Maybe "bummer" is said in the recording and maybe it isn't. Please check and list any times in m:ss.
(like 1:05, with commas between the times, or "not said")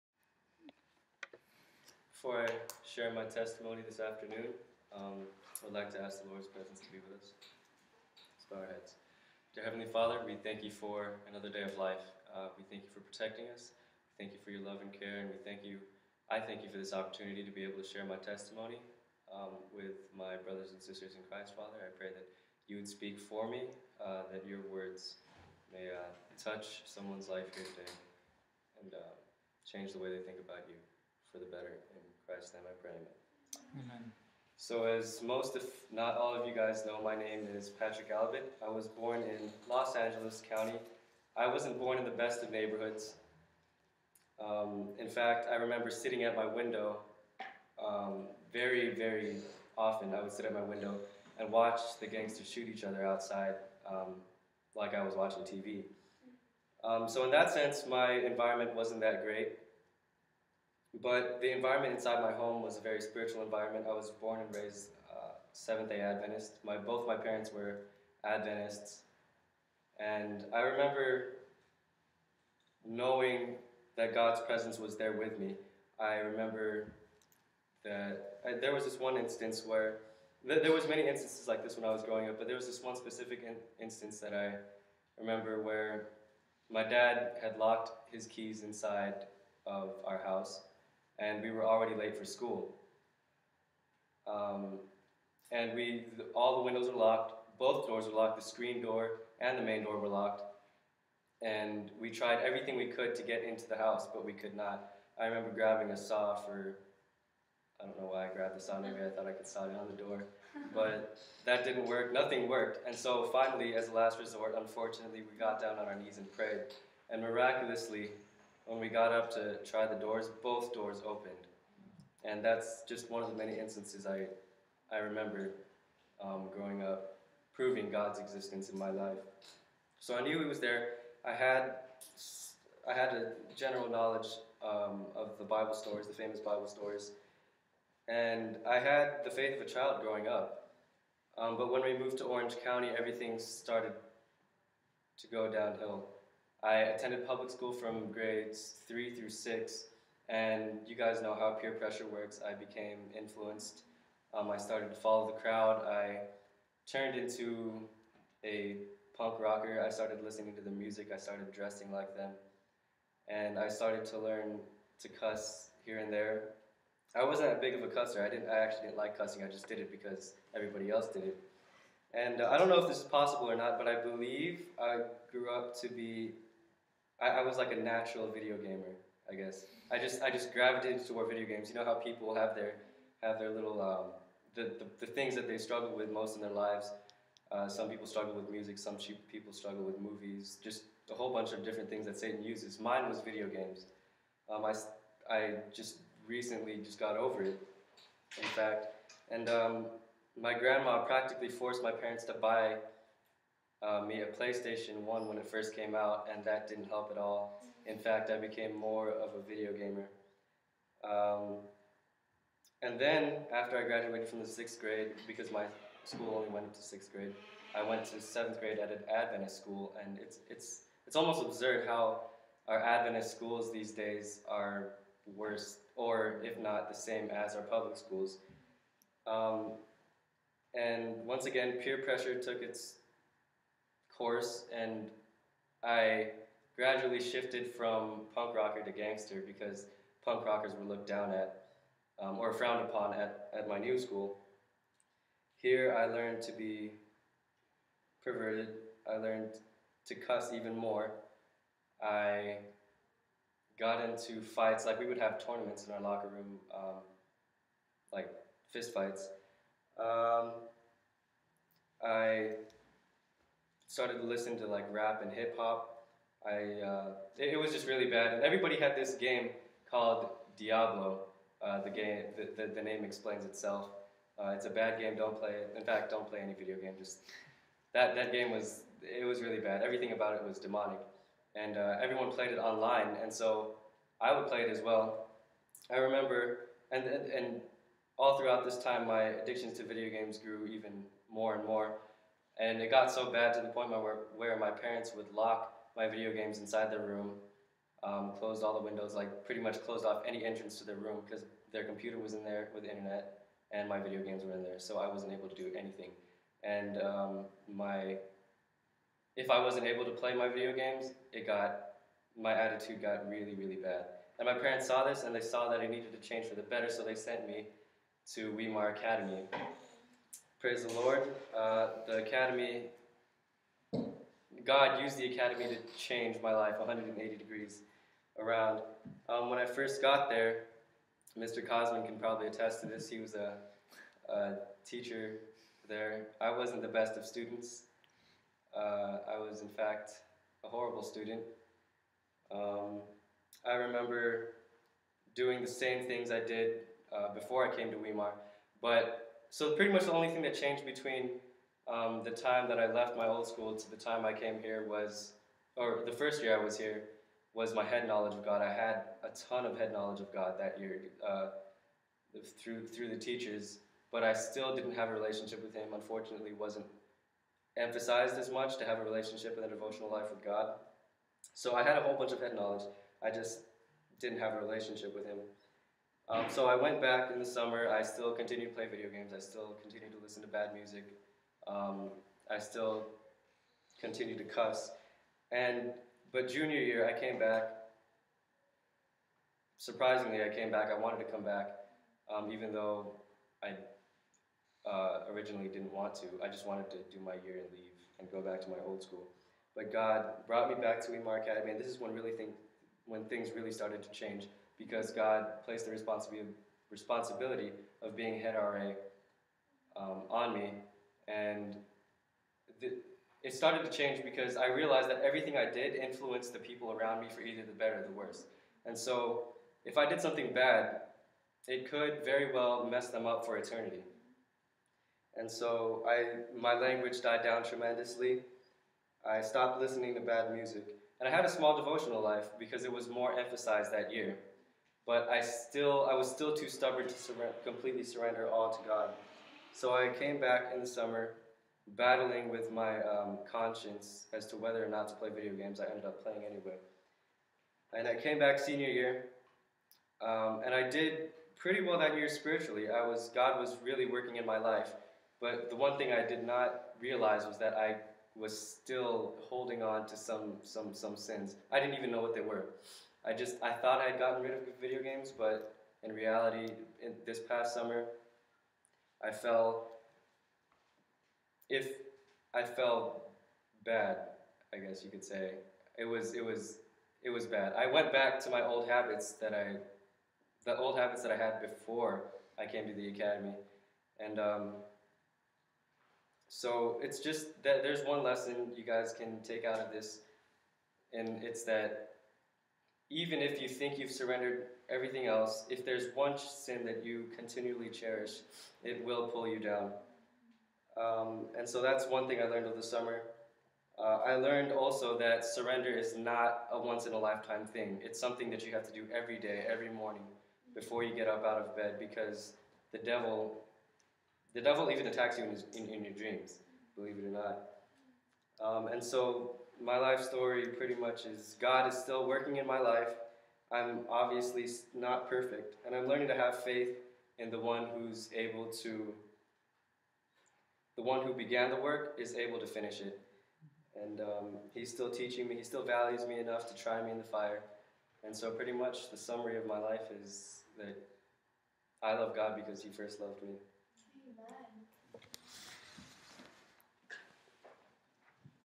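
not said.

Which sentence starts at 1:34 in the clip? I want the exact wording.
Um, and we, all the windows were locked, both doors were locked, the screen door and the main door were locked.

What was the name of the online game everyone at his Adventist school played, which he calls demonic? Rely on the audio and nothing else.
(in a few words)
Diablo.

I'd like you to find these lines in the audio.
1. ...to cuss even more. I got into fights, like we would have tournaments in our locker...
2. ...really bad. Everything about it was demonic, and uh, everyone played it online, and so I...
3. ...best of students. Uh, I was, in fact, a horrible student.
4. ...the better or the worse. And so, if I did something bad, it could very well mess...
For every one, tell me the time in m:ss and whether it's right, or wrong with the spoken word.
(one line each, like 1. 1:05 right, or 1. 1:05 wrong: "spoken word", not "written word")
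1. 4:10 right
2. 4:39 right
3. 5:36 right
4. 6:57 right.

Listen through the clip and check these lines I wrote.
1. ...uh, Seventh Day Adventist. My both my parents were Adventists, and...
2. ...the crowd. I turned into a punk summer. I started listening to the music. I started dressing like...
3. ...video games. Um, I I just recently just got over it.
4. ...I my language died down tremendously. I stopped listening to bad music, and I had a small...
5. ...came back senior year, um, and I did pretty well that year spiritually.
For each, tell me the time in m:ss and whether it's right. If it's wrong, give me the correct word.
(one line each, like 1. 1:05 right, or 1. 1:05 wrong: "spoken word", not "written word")
1. 1:05 right
2. 2:35 wrong: "rocker", not "summer"
3. 3:13 right
4. 7:06 right
5. 7:28 right.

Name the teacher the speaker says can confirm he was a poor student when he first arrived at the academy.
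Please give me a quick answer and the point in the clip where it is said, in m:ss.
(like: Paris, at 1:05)
Mr. Cosman, at 5:31.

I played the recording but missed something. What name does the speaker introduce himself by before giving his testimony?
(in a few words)
Patrick Albert.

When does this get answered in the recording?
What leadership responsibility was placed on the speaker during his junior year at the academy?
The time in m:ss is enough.
6:48.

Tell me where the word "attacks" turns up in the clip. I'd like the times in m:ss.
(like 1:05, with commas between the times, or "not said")
8:35.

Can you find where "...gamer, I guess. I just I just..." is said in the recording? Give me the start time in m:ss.
2:58.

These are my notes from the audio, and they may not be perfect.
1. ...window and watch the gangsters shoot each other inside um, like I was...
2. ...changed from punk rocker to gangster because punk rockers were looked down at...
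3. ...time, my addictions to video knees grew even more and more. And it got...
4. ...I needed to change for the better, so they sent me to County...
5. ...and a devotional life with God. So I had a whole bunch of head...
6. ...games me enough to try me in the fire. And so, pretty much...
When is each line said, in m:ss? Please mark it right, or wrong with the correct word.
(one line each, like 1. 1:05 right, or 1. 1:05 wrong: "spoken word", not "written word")
1. 0:50 wrong: "outside", not "inside"
2. 3:57 wrong: "shifted", not "changed"
3. 4:48 wrong: "games", not "knees"
4. 5:15 wrong: "Weimar", not "County"
5. 6:09 right
6. 8:55 wrong: "values", not "games".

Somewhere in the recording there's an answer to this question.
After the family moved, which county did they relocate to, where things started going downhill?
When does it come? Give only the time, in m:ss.
2:22.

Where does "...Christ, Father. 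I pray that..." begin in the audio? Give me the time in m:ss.
0:21.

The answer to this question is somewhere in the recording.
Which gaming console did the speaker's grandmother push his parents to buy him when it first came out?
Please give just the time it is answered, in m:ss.
3:24.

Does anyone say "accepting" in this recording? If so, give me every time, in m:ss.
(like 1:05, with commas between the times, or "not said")
not said.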